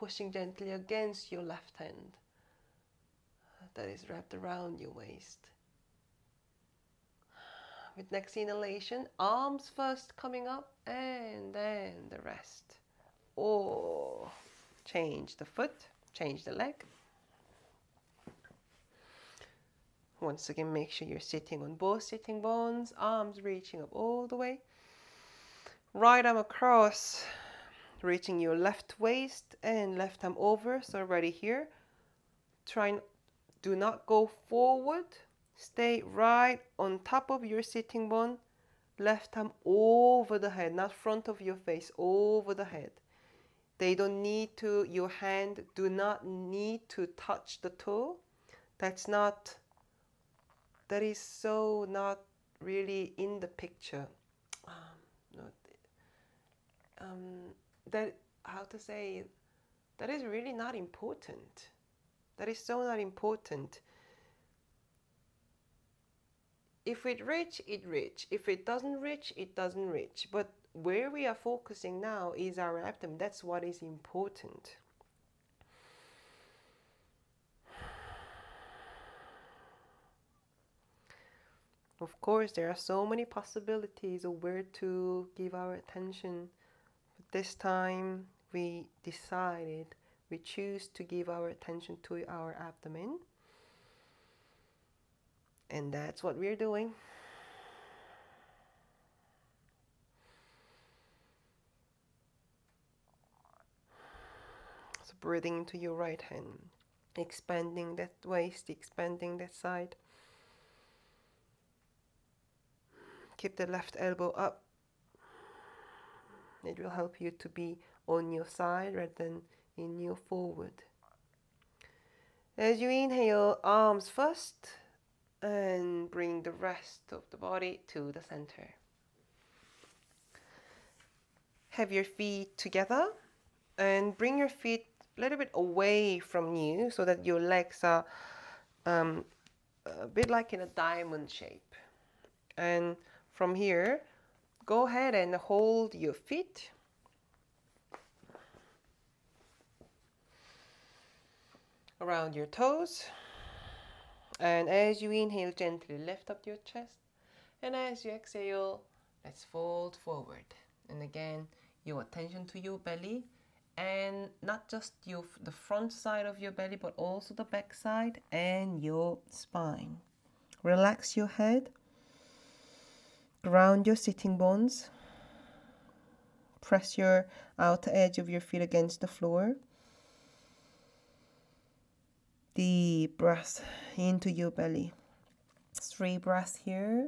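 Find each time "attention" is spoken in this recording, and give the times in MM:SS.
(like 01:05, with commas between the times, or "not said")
01:25, 01:31, 02:42.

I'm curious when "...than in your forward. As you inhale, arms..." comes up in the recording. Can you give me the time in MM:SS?
01:59.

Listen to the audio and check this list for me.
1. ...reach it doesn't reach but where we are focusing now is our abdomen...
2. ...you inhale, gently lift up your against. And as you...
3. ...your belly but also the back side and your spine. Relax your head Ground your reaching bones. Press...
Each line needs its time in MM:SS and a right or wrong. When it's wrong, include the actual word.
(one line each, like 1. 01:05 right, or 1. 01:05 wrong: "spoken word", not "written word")
1. 01:09 right
2. 02:35 wrong: "chest", not "against"
3. 02:46 wrong: "sitting", not "reaching".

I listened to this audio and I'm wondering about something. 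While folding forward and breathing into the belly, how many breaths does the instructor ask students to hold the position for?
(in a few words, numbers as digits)
3.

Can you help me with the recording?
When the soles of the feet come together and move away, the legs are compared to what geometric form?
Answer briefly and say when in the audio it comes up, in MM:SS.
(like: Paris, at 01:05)
diamond shape, at 02:20.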